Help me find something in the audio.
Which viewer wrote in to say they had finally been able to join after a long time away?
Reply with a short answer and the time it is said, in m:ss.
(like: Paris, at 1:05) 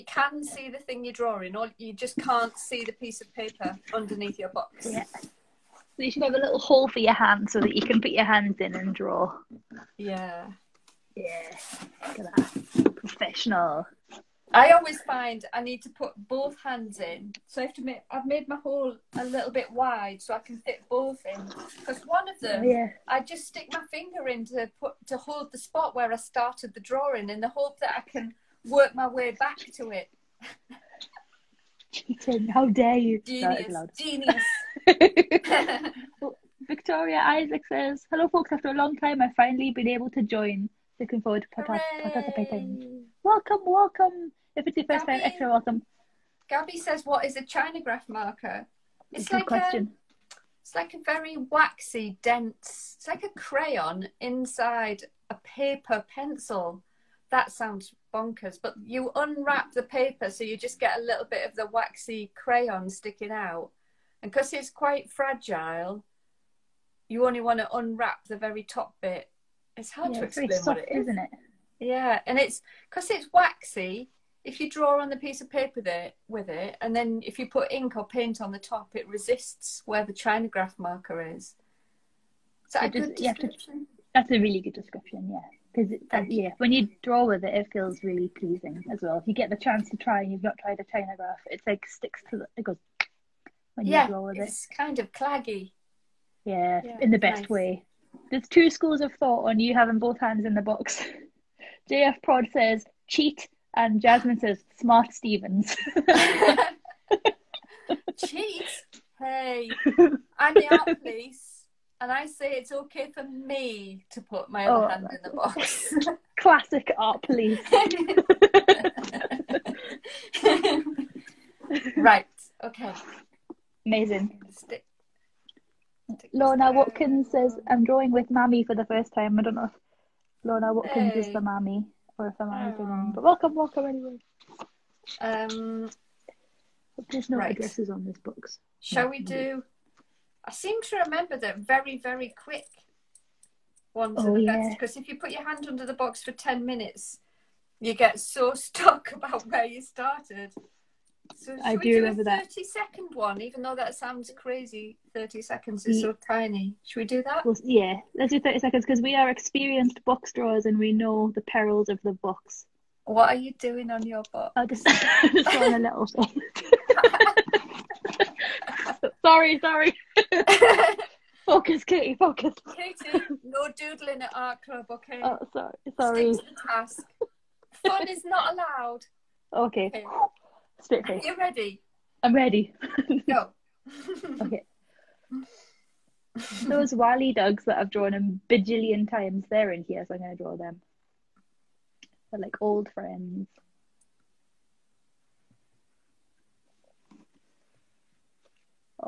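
Victoria Isaac, at 0:36.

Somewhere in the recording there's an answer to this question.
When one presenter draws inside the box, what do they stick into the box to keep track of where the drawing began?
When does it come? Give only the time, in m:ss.
0:23.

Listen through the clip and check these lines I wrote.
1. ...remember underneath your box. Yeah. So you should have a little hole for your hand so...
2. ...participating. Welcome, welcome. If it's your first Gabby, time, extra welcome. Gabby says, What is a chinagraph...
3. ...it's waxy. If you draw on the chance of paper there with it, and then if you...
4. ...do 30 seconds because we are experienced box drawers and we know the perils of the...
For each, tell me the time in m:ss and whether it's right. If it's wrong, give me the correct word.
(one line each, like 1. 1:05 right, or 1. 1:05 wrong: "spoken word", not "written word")
1. 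0:03 wrong: "paper", not "remember"
2. 0:42 right
3. 1:13 wrong: "piece", not "chance"
4. 2:38 right.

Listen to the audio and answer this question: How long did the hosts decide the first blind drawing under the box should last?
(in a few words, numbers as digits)
30 seconds.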